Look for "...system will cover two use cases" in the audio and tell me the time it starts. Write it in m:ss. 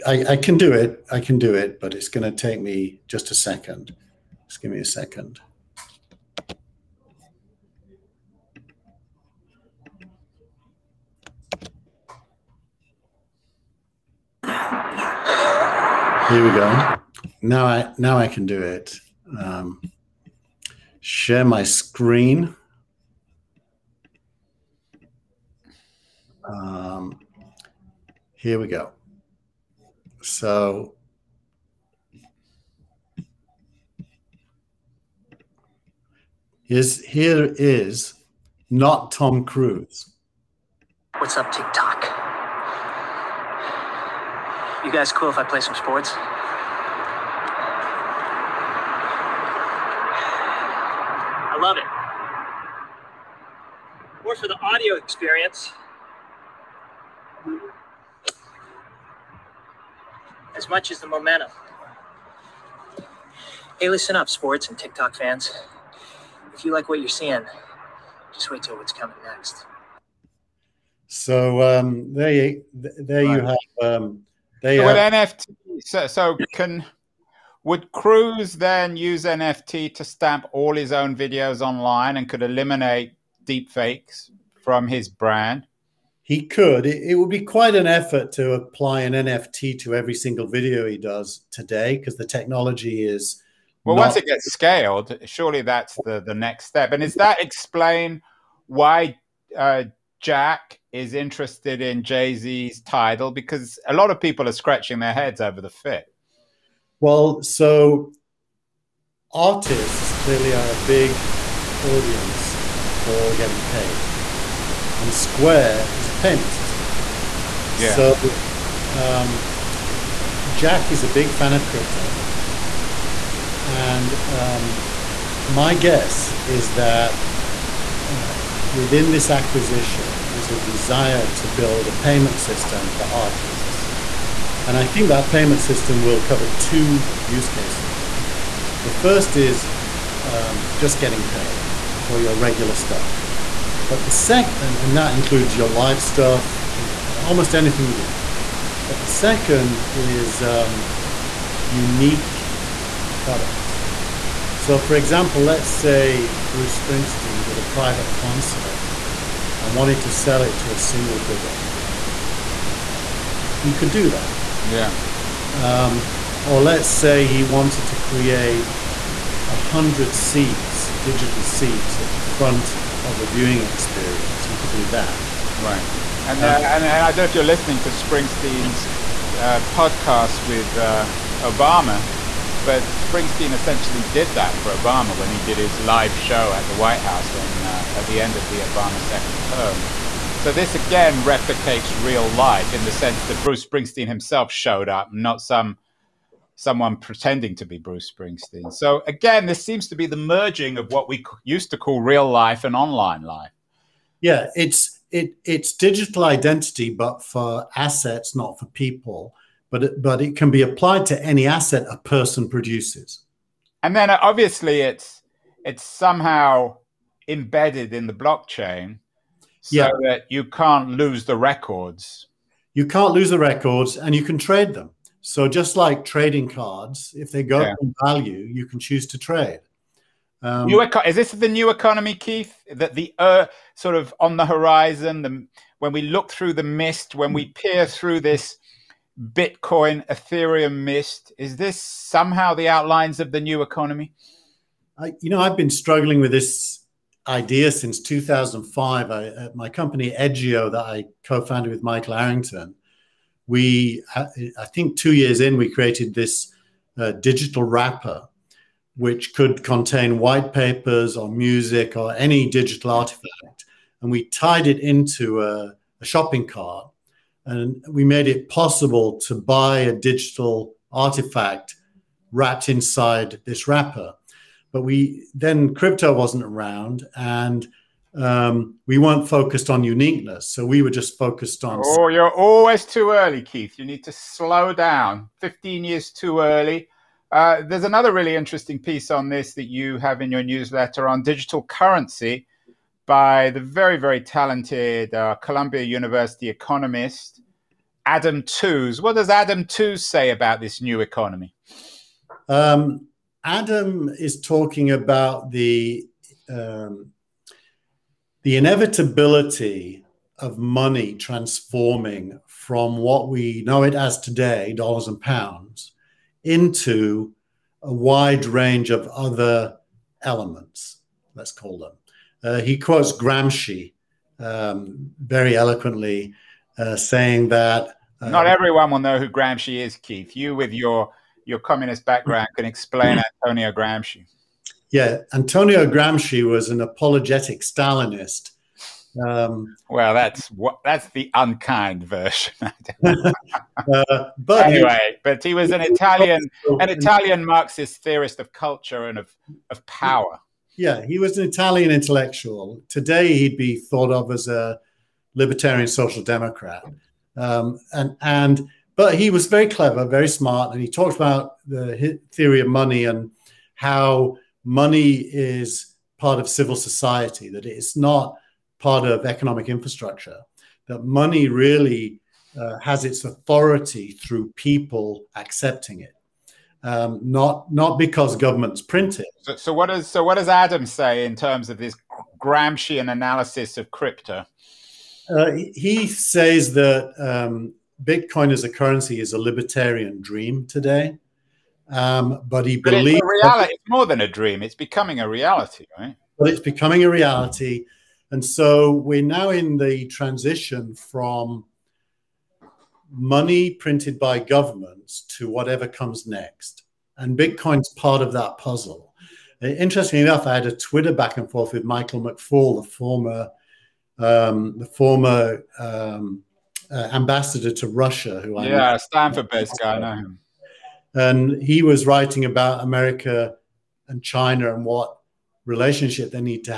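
2:15.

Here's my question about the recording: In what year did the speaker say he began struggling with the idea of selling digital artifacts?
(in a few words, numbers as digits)
2005.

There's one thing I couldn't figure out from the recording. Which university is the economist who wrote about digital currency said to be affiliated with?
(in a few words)
Columbia University.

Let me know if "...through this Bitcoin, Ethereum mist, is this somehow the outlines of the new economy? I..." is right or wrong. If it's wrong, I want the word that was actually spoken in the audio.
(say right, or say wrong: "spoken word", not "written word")
right.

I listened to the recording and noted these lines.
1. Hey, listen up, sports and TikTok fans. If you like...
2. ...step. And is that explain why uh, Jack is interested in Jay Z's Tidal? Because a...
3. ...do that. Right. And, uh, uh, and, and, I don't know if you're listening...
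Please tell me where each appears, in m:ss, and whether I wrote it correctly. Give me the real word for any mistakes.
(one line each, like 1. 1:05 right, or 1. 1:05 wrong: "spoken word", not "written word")
1. 1:03 right
2. 1:36 right
3. 2:54 right.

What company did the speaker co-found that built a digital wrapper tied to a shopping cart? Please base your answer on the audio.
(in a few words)
Edgeio.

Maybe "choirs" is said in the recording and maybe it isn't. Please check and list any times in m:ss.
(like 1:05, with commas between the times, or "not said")
not said.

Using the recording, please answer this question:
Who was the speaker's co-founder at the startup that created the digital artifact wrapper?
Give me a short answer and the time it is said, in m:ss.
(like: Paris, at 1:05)
Michael Arrington, at 4:11.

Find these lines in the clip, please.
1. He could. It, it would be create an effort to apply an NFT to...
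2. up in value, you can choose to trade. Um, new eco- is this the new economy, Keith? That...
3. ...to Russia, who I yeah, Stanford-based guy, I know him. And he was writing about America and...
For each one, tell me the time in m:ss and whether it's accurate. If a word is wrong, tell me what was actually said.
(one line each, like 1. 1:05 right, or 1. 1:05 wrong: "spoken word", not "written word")
1. 1:26 wrong: "quite", not "create"
2. 3:47 right
3. 6:57 right.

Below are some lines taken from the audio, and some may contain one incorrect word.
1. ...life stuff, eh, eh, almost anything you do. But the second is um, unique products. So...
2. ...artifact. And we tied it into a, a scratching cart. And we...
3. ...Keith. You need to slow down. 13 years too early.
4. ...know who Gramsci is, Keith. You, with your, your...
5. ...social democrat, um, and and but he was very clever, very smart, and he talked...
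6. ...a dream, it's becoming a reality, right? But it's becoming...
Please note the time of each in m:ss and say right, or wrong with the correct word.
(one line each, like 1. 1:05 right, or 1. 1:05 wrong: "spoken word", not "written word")
1. 2:25 right
2. 4:22 wrong: "shopping", not "scratching"
3. 4:43 wrong: "15", not "13"
4. 5:28 right
5. 5:55 right
6. 6:34 right.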